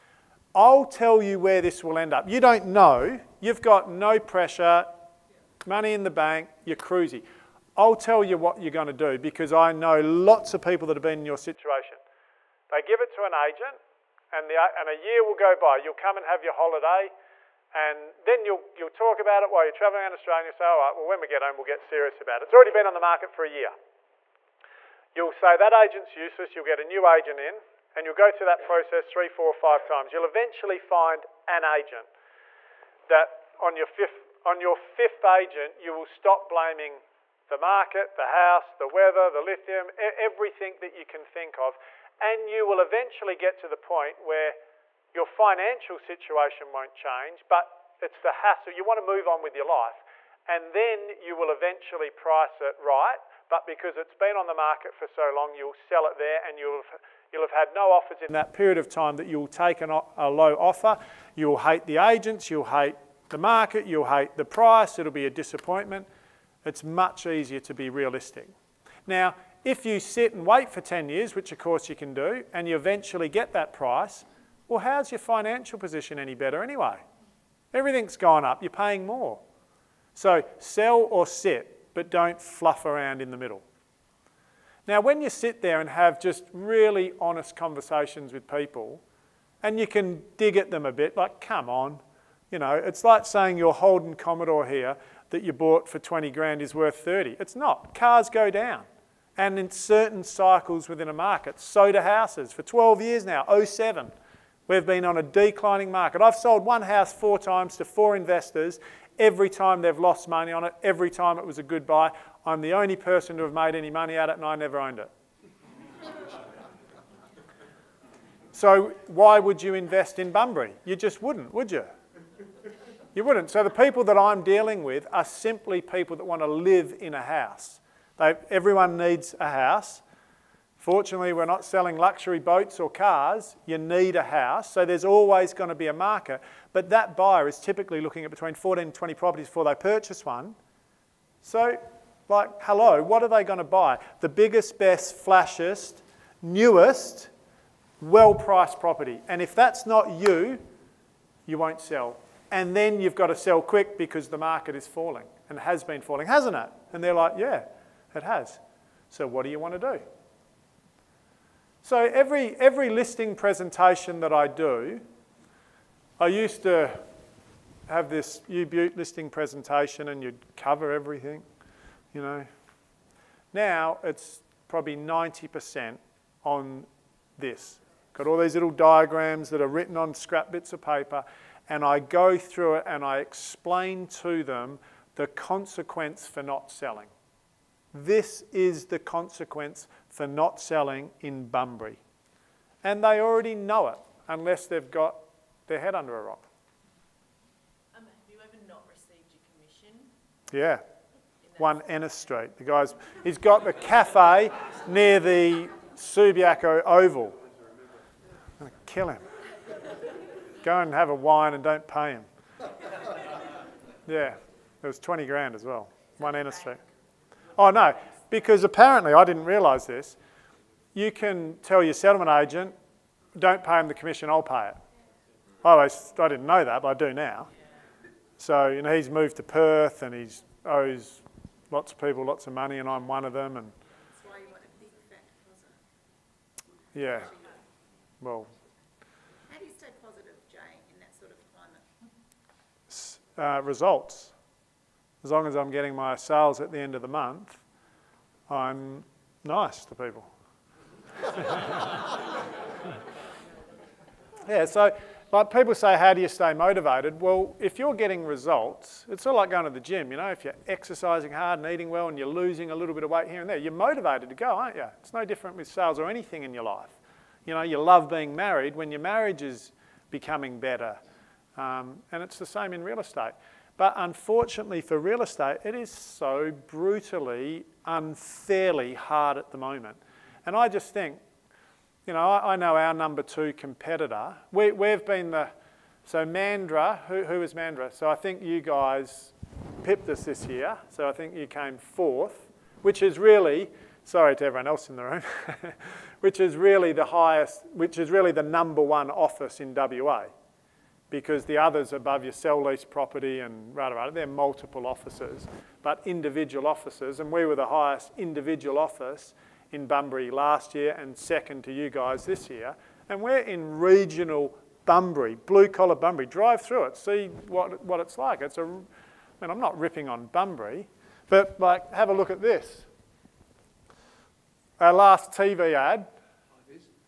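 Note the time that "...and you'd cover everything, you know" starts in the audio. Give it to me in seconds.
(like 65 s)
170 s.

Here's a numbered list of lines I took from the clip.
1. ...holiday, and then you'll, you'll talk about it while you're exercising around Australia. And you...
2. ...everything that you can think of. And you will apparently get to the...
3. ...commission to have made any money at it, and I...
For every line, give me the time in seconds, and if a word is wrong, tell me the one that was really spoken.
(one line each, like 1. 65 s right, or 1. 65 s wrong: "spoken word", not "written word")
1. 16 s wrong: "traveling", not "exercising"
2. 39 s wrong: "eventually", not "apparently"
3. 112 s wrong: "person", not "commission".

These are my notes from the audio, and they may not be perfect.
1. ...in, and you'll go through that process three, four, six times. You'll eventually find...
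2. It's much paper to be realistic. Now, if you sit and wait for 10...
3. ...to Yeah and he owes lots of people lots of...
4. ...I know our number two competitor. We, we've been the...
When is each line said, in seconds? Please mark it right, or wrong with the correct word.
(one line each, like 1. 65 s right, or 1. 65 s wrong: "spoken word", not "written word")
1. 27 s wrong: "five", not "six"
2. 66 s wrong: "easier", not "paper"
3. 229 s wrong: "Perth", not "Yeah"
4. 282 s right.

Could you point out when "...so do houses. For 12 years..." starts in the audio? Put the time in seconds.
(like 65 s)
101 s.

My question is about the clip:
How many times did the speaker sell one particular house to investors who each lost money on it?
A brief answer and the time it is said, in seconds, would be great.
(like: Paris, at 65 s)
4, at 107 s.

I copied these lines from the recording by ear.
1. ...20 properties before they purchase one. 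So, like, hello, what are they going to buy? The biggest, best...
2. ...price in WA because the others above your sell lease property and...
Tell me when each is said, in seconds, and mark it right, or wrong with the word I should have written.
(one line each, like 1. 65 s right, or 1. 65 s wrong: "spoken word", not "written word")
1. 138 s right
2. 299 s wrong: "office", not "price".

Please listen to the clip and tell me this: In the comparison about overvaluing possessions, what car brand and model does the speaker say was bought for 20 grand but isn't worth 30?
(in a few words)
Holden Commodore.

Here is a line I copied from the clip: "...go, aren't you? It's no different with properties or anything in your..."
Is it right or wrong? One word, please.
wrong.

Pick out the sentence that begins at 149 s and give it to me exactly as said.
And if that's not you, you won't sell.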